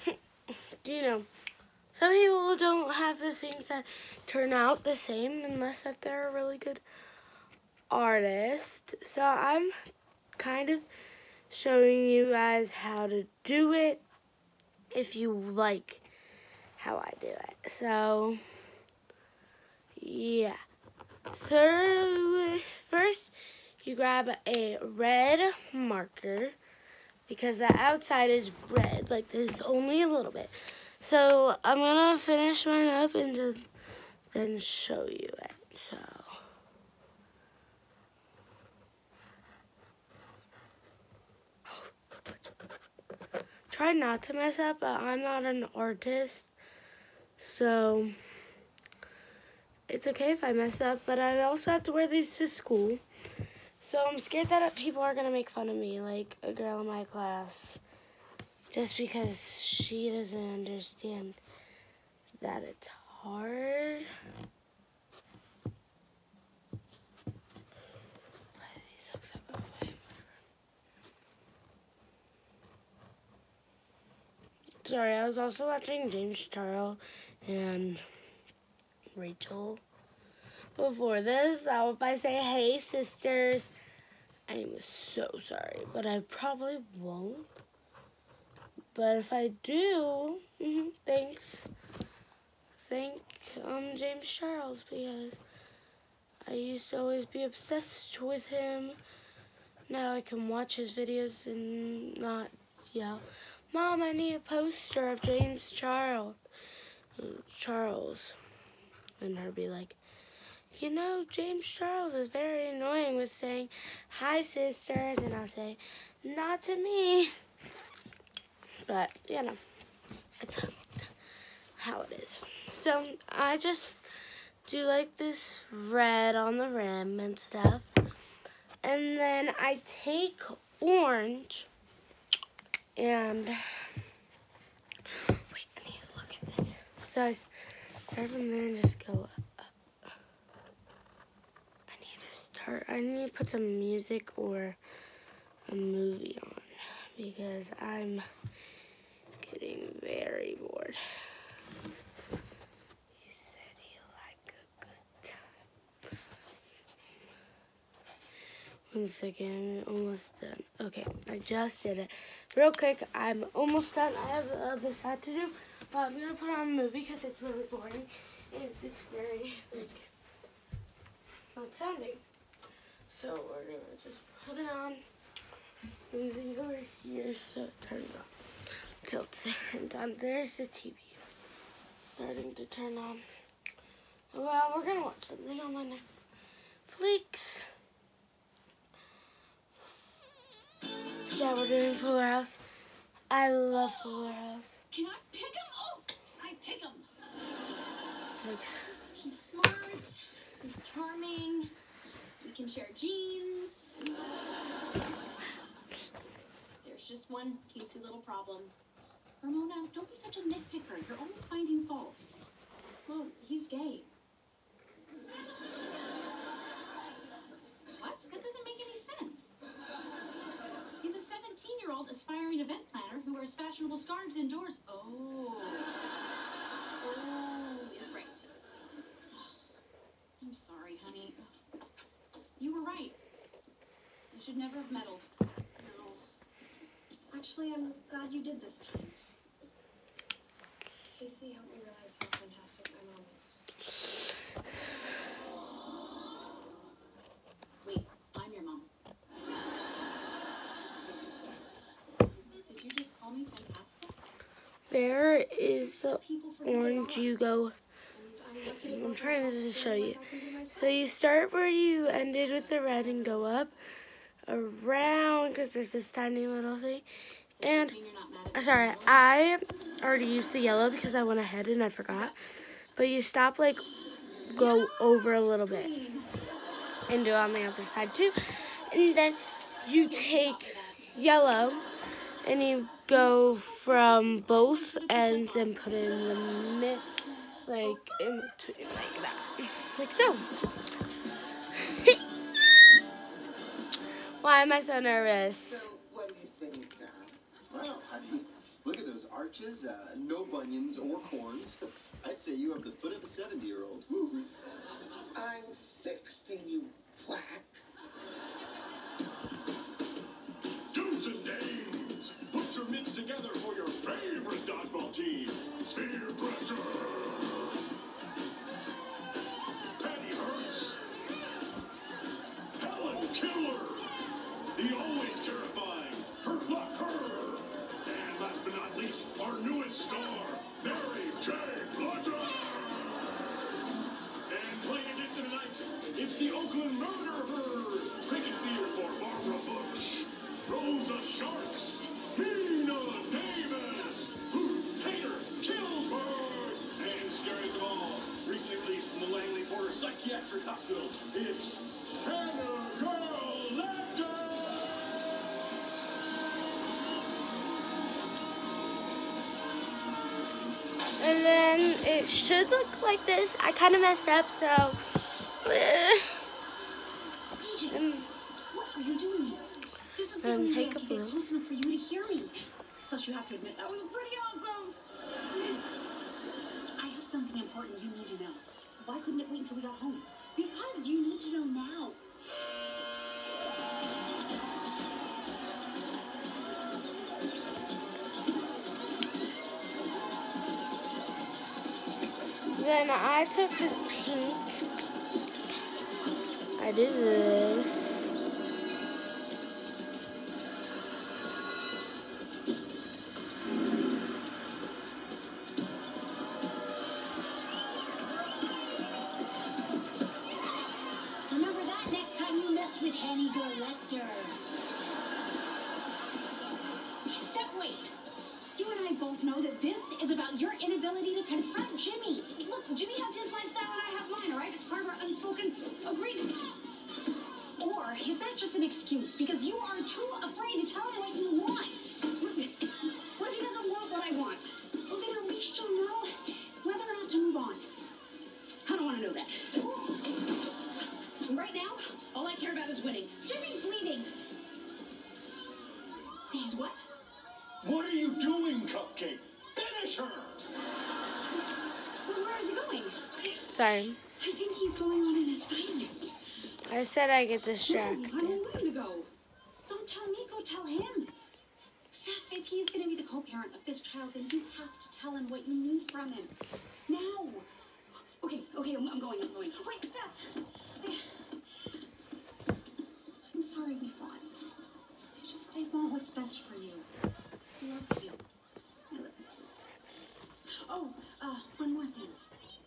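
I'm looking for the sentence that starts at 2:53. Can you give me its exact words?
So we're going to just put it on.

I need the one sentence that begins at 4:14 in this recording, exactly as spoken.
There is the orange you go.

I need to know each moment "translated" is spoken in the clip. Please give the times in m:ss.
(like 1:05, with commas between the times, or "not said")
not said.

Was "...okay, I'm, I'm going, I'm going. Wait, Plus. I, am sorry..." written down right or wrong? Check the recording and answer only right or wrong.
wrong.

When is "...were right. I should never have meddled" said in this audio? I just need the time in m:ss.
3:52.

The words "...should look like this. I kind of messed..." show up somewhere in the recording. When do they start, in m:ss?
6:02.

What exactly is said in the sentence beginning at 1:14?
Sorry, I was also watching James Charles and Rachel.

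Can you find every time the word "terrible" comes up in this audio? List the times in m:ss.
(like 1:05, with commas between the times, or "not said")
not said.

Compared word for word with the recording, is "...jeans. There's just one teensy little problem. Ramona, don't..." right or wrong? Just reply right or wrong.
right.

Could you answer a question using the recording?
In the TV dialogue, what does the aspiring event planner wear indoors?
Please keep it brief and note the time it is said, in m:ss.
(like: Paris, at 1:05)
fashionable scarves, at 3:43.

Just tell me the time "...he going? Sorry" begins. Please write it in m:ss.
7:32.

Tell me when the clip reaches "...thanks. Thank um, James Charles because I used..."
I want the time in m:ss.
1:31.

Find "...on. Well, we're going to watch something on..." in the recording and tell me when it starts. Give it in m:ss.
3:02.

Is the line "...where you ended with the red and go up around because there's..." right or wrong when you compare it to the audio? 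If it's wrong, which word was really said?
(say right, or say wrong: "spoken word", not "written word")
right.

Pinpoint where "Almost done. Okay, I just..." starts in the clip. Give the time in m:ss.
2:39.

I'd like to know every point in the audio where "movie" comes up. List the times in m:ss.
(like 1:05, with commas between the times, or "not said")
2:25, 2:46.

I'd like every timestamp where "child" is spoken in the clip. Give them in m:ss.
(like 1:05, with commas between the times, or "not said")
7:44.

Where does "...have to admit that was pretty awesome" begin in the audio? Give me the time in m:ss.
6:13.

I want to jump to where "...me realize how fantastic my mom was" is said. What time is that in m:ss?
4:01.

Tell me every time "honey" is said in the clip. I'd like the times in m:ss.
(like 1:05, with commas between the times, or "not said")
3:51, 4:58.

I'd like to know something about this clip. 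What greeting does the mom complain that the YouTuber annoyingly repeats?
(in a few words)
hi, sisters.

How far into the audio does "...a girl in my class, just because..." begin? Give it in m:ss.
0:56.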